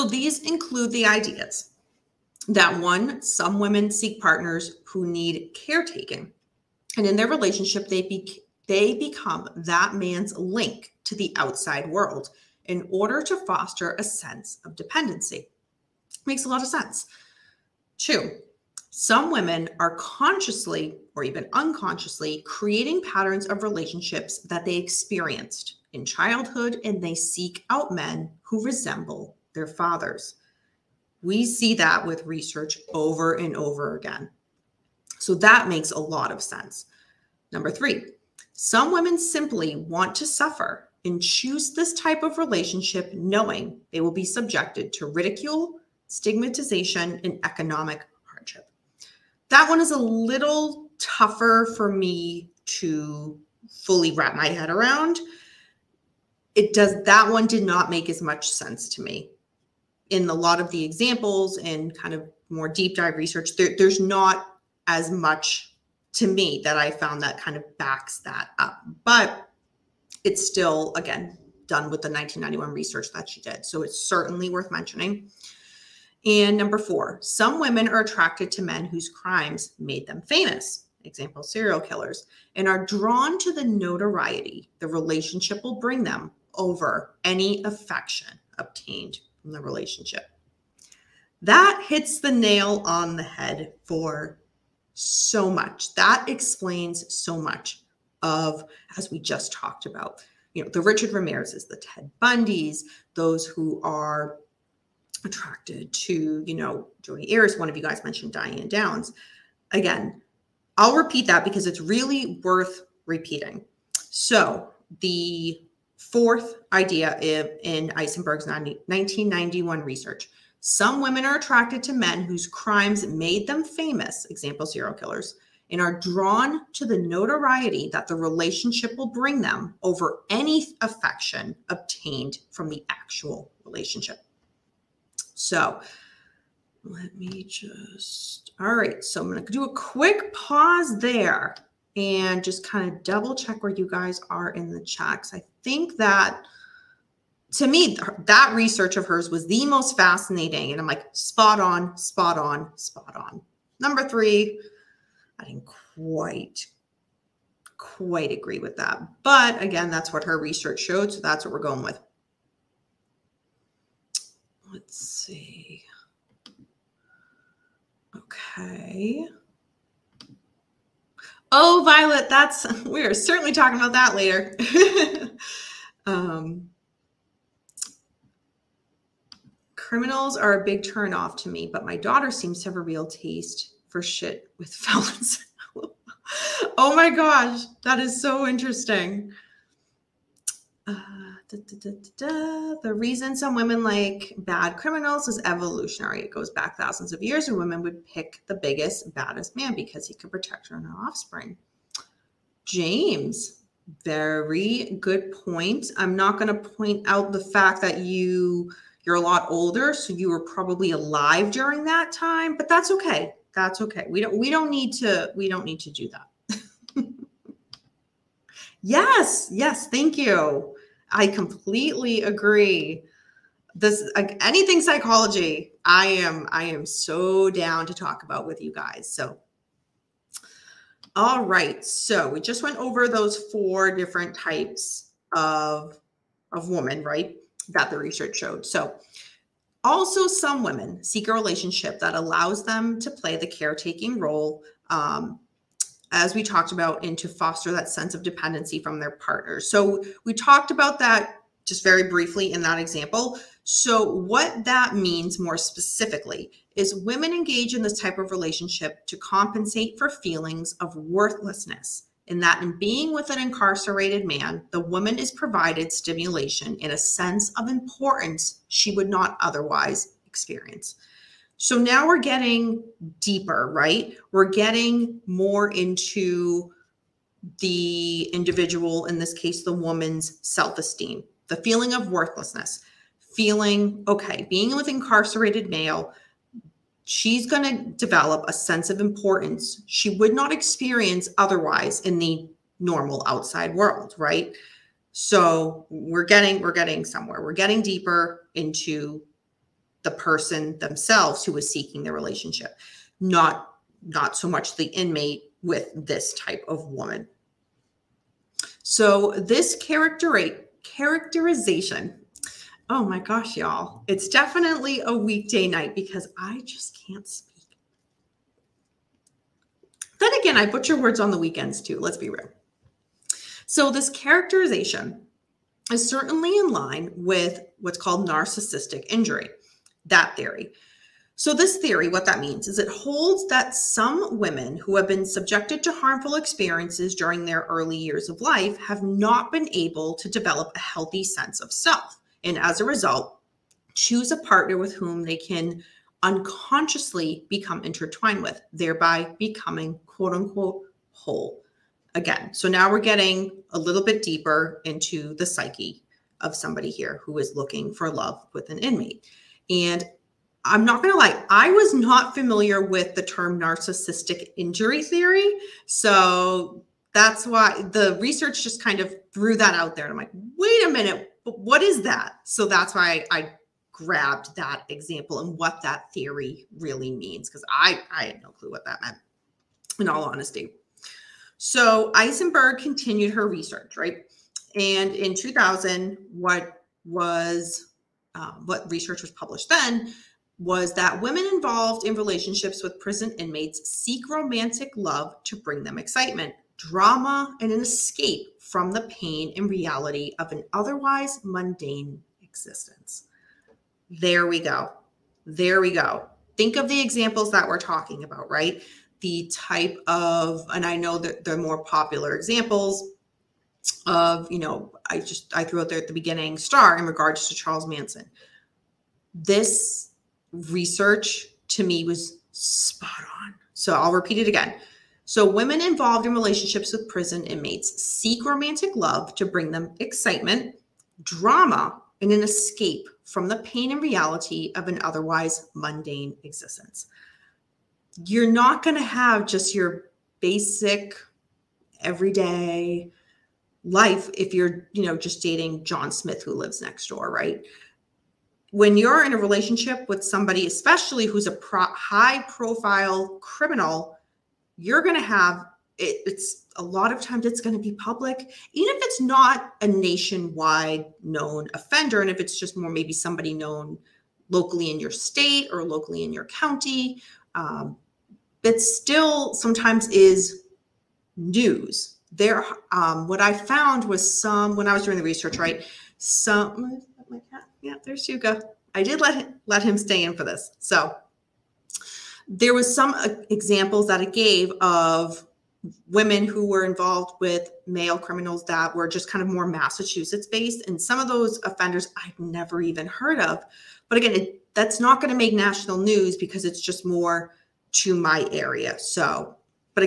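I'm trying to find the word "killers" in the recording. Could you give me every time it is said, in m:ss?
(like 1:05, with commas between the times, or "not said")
1:21, 2:04.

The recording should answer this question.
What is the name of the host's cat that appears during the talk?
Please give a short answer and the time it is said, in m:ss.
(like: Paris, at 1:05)
Yuga, at 7:58.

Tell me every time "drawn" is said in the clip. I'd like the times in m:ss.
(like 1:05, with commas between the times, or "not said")
1:22, 2:06.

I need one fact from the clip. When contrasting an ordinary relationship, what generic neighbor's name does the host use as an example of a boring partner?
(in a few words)
John Smith.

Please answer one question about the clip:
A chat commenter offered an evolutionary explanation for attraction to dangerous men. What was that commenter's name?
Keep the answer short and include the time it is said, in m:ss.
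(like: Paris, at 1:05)
James, at 3:22.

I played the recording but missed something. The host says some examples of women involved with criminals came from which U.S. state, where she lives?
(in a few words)
Massachusetts.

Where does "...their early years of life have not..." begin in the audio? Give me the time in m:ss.
5:37.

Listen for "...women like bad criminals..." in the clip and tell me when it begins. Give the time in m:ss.
3:13.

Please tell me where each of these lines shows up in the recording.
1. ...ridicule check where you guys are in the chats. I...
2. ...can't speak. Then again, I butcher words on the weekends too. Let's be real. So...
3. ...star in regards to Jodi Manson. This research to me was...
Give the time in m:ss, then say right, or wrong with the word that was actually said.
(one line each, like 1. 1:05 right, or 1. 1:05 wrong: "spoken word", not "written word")
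1. 2:23 wrong: "double", not "ridicule"
2. 5:17 right
3. 6:56 wrong: "Charles", not "Jodi".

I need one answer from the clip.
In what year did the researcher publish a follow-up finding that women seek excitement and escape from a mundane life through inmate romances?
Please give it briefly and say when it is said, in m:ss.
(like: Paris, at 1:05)
2000, at 6:25.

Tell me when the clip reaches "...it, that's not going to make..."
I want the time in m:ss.
8:14.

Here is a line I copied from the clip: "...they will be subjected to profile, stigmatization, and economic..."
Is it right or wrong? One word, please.
wrong.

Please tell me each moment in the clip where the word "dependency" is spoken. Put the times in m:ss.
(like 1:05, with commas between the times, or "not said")
0:14, 4:08.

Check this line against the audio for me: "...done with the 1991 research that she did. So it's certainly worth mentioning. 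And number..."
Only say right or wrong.
right.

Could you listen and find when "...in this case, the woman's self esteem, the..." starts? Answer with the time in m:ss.
4:39.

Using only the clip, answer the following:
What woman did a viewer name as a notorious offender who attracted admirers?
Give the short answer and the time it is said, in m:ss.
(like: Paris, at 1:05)
Diane Downs, at 1:48.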